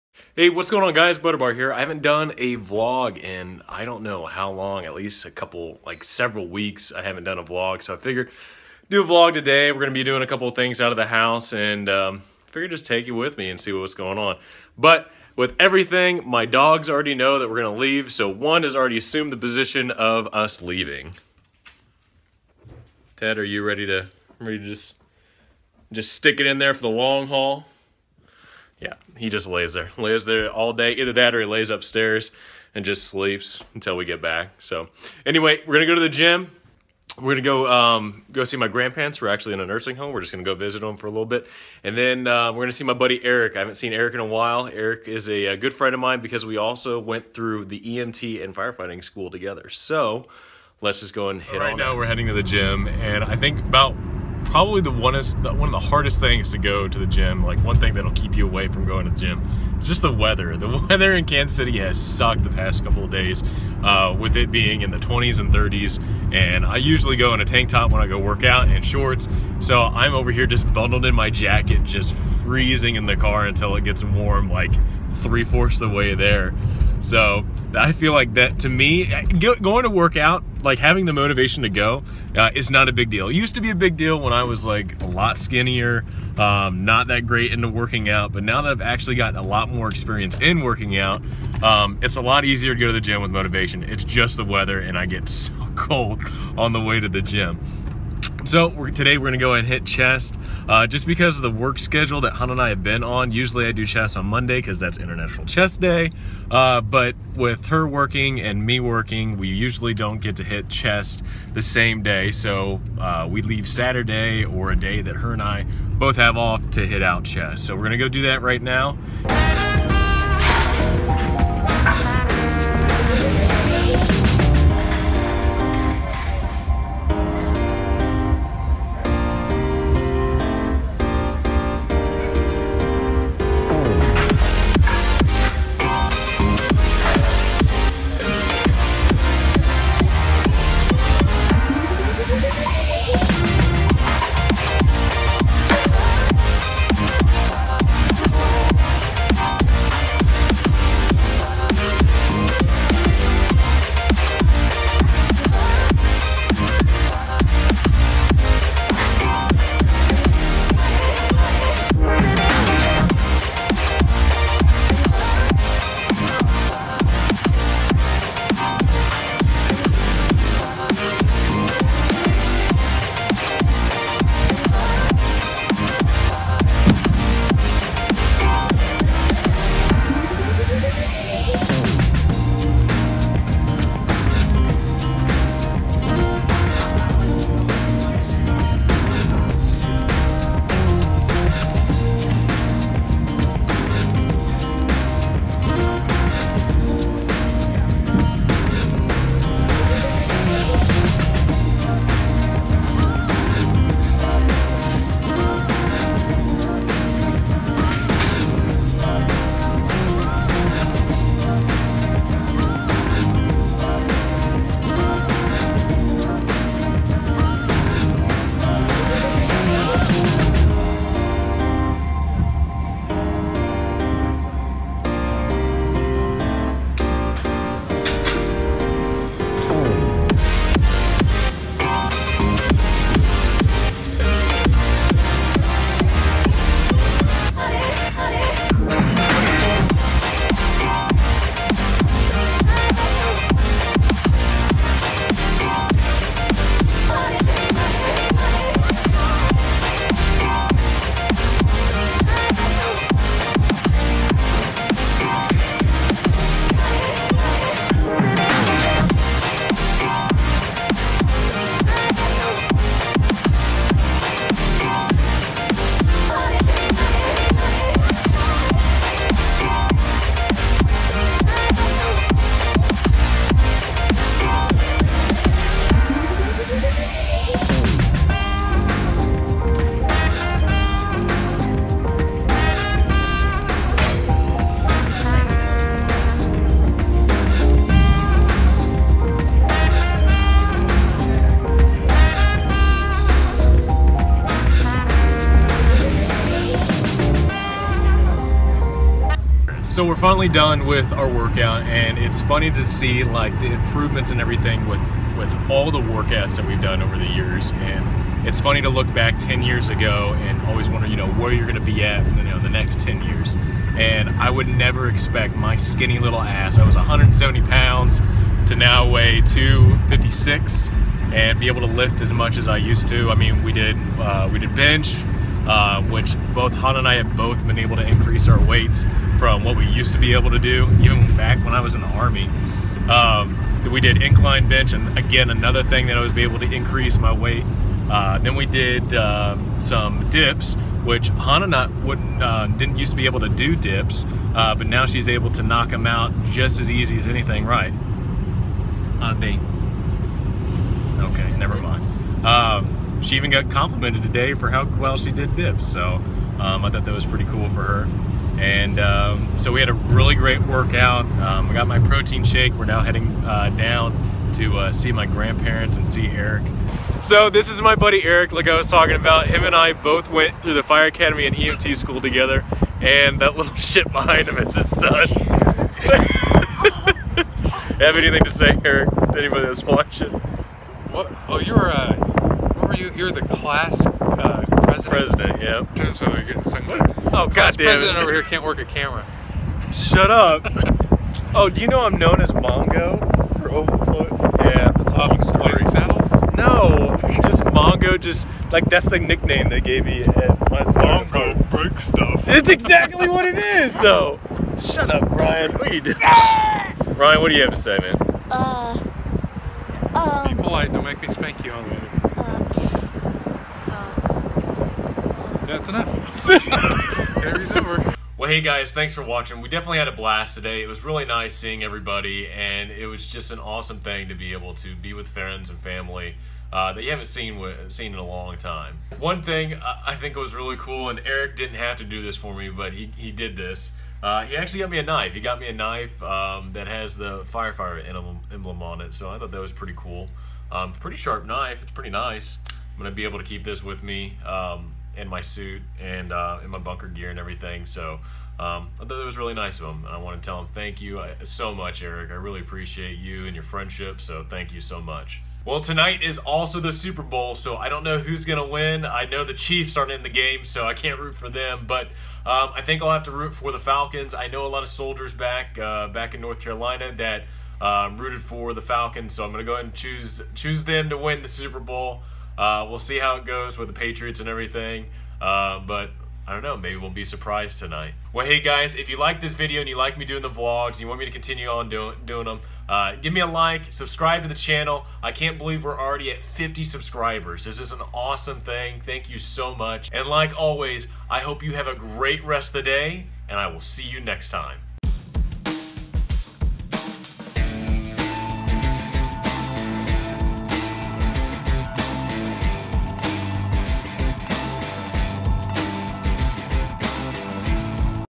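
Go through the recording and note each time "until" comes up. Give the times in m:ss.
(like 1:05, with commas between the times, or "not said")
0:33, 1:13.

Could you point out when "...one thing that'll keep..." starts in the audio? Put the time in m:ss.
0:57.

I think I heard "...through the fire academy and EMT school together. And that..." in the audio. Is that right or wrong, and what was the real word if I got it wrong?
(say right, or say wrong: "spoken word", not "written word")
right.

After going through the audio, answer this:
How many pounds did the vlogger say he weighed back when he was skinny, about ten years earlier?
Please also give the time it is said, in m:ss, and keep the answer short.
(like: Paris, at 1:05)
170, at 5:16.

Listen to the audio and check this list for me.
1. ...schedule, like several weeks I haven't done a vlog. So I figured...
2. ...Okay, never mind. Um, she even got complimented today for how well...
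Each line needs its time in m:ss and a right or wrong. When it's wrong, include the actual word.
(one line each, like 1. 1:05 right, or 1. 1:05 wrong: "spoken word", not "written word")
1. 0:05 wrong: "couple", not "schedule"
2. 5:51 right.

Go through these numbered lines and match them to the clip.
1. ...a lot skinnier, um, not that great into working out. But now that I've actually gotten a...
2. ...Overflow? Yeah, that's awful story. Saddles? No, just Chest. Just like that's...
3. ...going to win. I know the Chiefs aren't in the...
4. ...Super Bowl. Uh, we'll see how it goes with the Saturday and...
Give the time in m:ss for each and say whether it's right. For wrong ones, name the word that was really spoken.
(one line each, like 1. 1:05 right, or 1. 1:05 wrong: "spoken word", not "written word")
1. 1:25 right
2. 6:33 wrong: "Mongo", not "Chest"
3. 7:38 right
4. 7:51 wrong: "Patriots", not "Saturday".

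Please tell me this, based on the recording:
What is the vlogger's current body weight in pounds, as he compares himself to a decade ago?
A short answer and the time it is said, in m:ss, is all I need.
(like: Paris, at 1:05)
256, at 5:19.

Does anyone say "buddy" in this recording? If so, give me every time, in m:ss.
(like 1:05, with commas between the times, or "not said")
0:42, 6:07.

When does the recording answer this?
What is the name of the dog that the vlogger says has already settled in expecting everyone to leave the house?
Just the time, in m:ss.
0:23.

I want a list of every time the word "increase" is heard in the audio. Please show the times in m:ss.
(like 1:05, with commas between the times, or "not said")
5:28, 5:36.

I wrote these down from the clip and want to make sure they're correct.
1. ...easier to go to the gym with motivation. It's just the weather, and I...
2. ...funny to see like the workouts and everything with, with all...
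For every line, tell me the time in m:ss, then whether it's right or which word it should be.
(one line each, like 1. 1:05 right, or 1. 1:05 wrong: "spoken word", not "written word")
1. 1:32 right
2. 5:02 wrong: "improvements", not "workouts".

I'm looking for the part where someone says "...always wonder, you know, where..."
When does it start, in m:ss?
5:10.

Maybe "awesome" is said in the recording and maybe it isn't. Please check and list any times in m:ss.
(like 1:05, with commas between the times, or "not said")
7:03, 8:08.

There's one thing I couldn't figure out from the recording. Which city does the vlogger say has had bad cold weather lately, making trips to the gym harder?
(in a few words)
Kansas City.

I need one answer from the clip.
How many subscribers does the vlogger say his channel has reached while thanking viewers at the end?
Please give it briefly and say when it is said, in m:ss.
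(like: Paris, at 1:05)
50, at 8:06.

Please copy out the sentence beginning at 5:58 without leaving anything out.
And um, so we had a really great workout.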